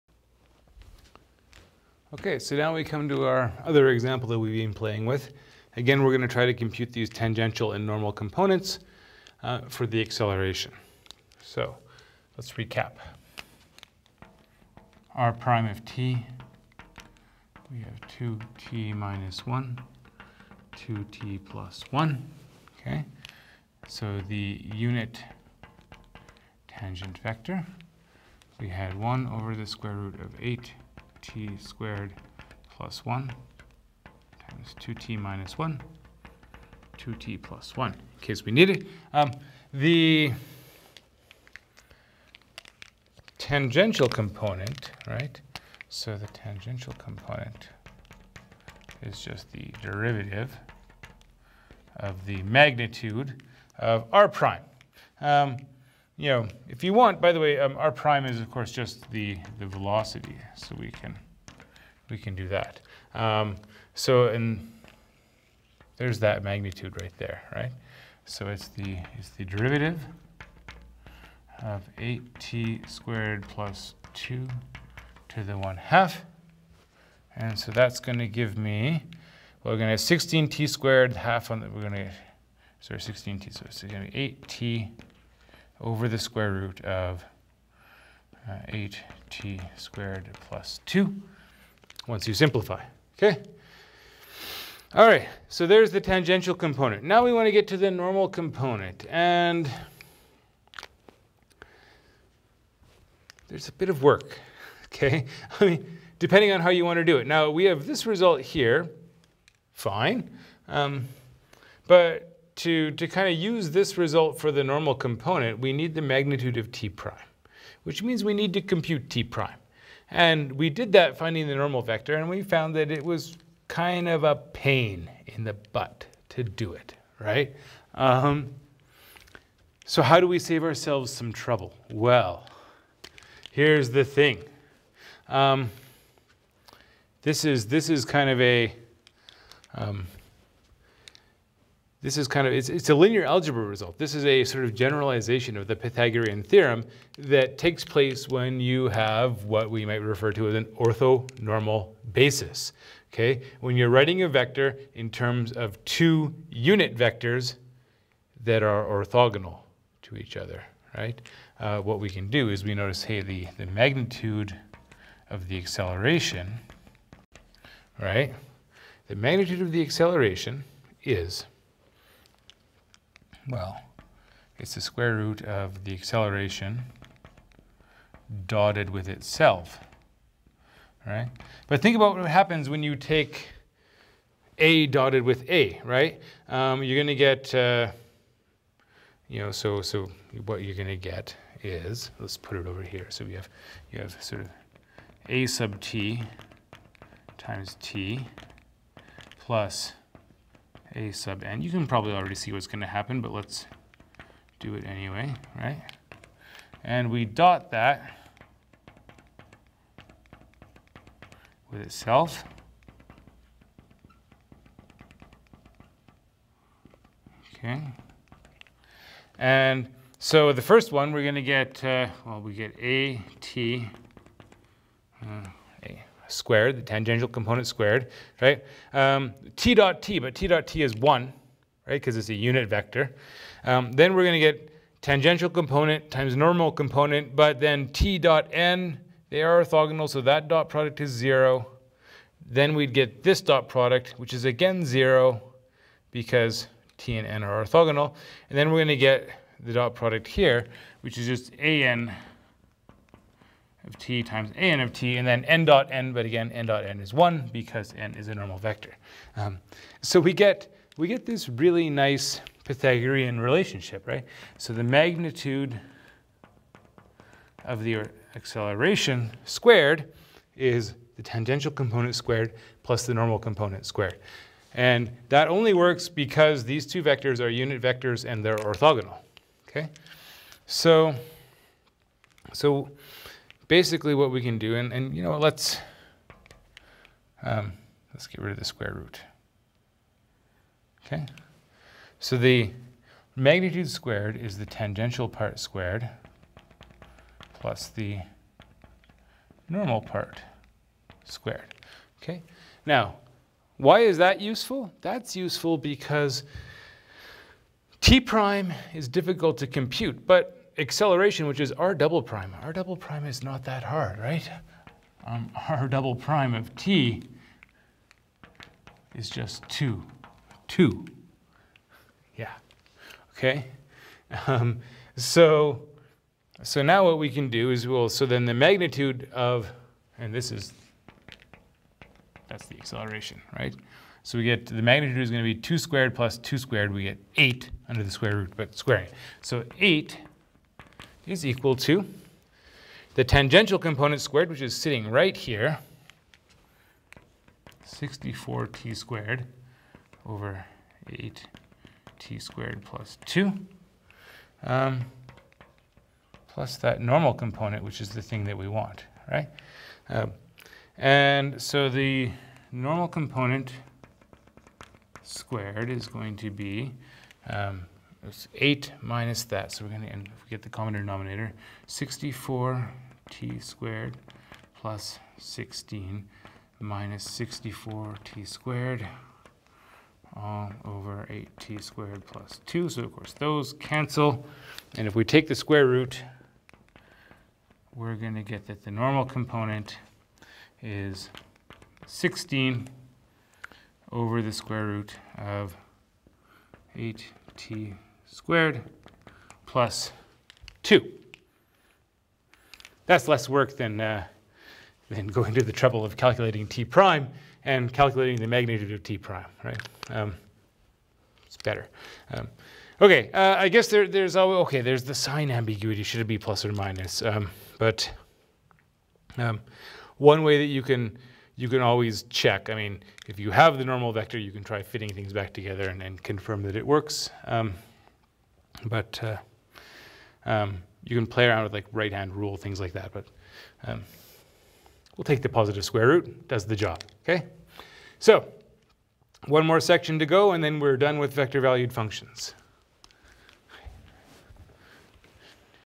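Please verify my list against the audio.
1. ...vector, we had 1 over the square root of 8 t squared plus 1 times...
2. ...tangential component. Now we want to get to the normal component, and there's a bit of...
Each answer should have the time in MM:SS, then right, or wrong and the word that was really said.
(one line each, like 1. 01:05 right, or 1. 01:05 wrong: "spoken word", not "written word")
1. 00:27 right
2. 01:36 right.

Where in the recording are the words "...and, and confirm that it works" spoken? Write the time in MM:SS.
07:05.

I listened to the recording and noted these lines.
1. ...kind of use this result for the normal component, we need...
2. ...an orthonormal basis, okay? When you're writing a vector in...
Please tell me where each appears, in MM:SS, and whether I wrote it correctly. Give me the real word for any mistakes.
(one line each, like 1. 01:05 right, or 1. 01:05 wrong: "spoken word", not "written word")
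1. 01:53 right
2. 02:30 right.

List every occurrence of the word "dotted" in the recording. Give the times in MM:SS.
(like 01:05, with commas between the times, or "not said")
02:58, 03:04.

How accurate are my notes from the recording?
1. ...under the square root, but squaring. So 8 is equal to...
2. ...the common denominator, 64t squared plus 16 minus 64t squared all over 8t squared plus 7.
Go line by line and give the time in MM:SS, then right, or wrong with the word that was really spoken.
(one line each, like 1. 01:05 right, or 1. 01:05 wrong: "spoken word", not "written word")
1. 05:37 right
2. 06:10 wrong: "2", not "7".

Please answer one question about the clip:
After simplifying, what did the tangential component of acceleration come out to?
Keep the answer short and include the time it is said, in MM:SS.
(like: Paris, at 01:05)
8t / sqrt(8t^2 + 2), at 01:24.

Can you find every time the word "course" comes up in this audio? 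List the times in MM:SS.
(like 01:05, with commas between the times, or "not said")
00:58, 06:23.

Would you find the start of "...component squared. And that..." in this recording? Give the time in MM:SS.
04:33.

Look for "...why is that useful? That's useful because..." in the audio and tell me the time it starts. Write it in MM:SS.
05:03.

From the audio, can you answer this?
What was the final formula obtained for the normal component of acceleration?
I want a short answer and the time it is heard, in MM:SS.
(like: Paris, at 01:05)
16 / sqrt(8t^2 + 2), at 06:32.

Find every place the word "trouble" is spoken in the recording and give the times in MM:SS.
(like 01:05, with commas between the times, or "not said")
02:11, 06:45.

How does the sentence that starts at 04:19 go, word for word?
Um, so we get, we get this really nice Pythagorean relationship, right?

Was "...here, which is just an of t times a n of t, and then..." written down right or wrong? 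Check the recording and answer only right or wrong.
right.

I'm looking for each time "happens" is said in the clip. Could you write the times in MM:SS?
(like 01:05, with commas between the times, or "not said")
03:02, 03:22.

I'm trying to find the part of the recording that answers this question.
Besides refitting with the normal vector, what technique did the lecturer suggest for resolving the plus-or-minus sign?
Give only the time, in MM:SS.
07:11.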